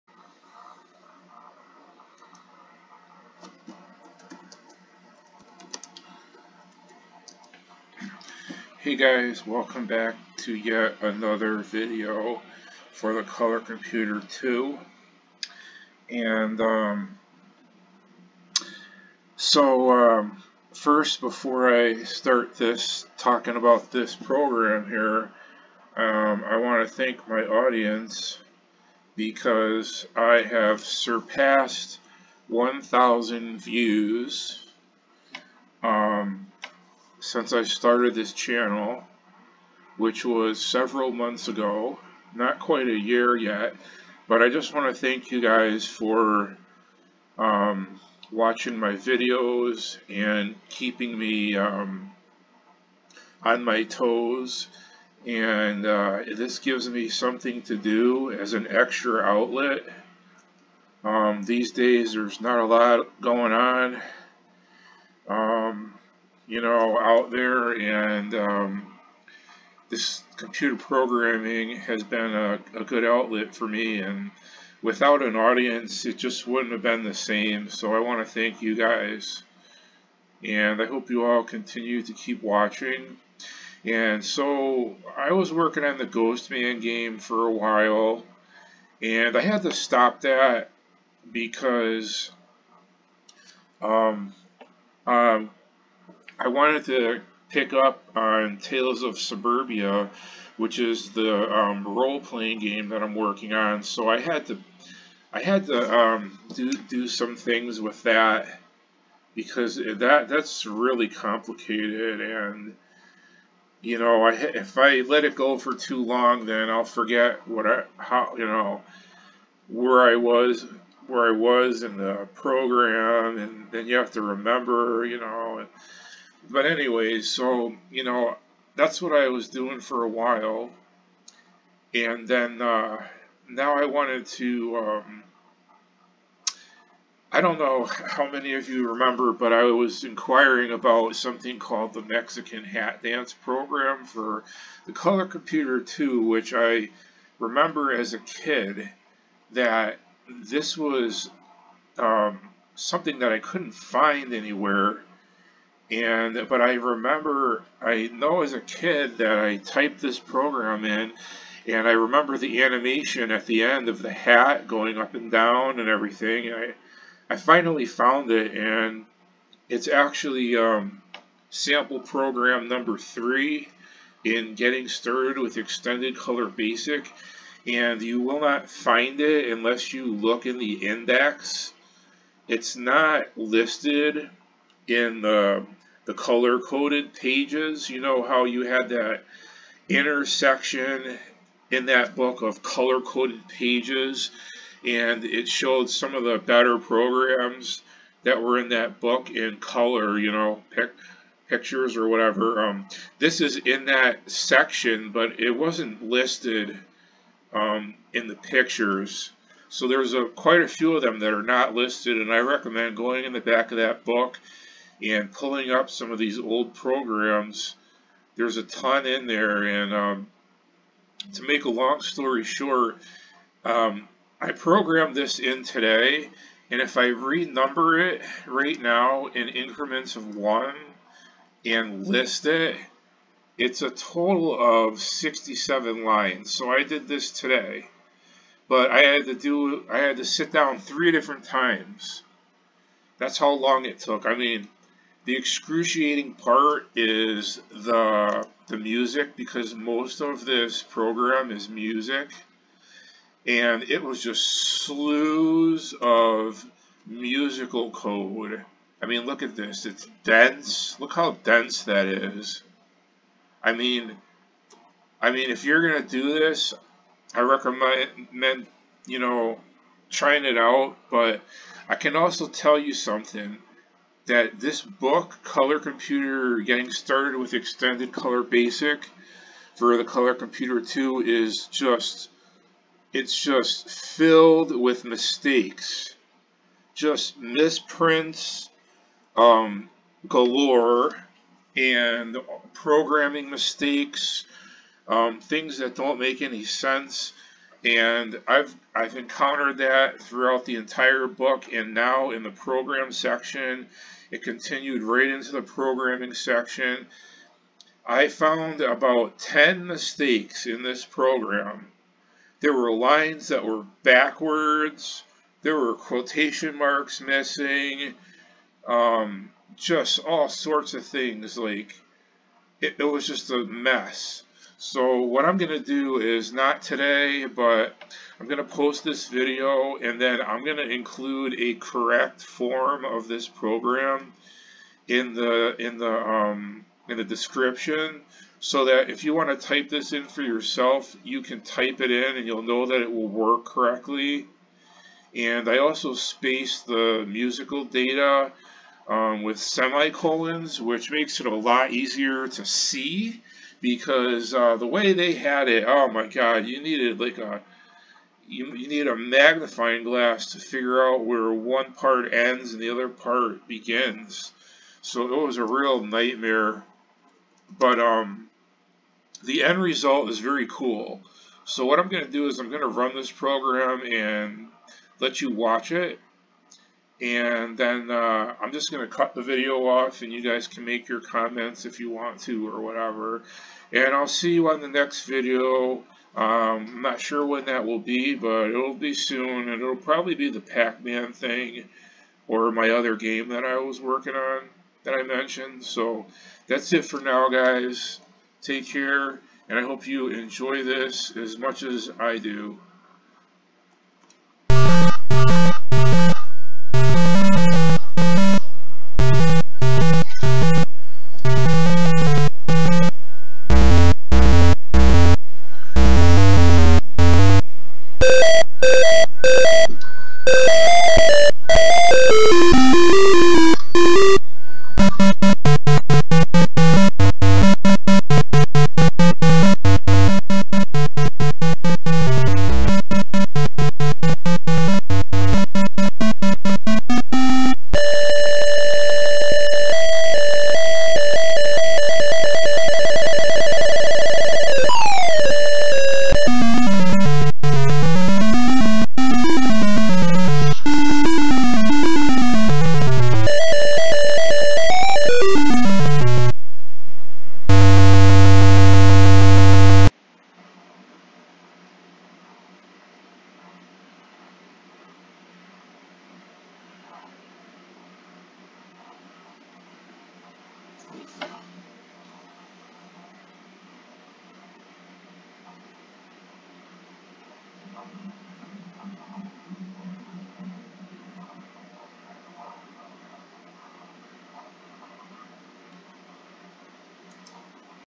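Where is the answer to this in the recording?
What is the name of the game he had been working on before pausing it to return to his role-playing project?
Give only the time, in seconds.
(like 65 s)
86 s.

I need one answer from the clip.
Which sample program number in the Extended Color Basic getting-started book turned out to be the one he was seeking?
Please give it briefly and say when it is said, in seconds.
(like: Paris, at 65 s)
3, at 172 s.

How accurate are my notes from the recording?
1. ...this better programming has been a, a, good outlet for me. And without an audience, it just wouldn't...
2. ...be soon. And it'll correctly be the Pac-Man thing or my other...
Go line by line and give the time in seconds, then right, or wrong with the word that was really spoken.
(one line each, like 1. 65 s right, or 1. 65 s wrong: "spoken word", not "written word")
1. 69 s wrong: "computer", not "better"
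2. 388 s wrong: "probably", not "correctly".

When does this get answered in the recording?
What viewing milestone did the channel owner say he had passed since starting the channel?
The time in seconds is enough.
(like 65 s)
32 s.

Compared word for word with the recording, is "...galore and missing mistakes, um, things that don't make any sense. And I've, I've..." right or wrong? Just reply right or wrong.
wrong.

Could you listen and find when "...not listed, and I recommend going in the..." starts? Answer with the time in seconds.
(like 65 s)
211 s.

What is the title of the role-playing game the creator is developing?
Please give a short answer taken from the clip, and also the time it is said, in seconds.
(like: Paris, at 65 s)
Tales of Suburbia, at 98 s.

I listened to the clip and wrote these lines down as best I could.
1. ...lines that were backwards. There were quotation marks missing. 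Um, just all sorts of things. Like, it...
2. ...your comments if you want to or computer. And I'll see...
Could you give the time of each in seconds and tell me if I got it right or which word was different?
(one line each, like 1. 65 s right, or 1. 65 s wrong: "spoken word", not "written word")
1. 312 s right
2. 381 s wrong: "whatever", not "computer".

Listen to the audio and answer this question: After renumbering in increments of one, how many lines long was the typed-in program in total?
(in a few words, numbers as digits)
67.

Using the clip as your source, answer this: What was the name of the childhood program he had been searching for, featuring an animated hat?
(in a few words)
Mexican Hat Dance.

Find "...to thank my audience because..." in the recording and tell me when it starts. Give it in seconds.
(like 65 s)
26 s.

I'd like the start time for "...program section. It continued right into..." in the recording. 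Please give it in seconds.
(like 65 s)
302 s.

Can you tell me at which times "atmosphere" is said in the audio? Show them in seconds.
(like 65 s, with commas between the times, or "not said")
not said.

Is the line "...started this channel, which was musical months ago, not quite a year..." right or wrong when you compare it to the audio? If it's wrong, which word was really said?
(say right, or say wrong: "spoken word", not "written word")
wrong: "several", not "musical".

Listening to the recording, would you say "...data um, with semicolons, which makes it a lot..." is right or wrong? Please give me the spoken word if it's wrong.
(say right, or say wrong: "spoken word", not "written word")
right.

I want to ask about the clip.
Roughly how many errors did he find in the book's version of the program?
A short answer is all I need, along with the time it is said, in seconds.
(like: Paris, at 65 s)
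10, at 308 s.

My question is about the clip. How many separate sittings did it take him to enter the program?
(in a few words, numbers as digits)
3.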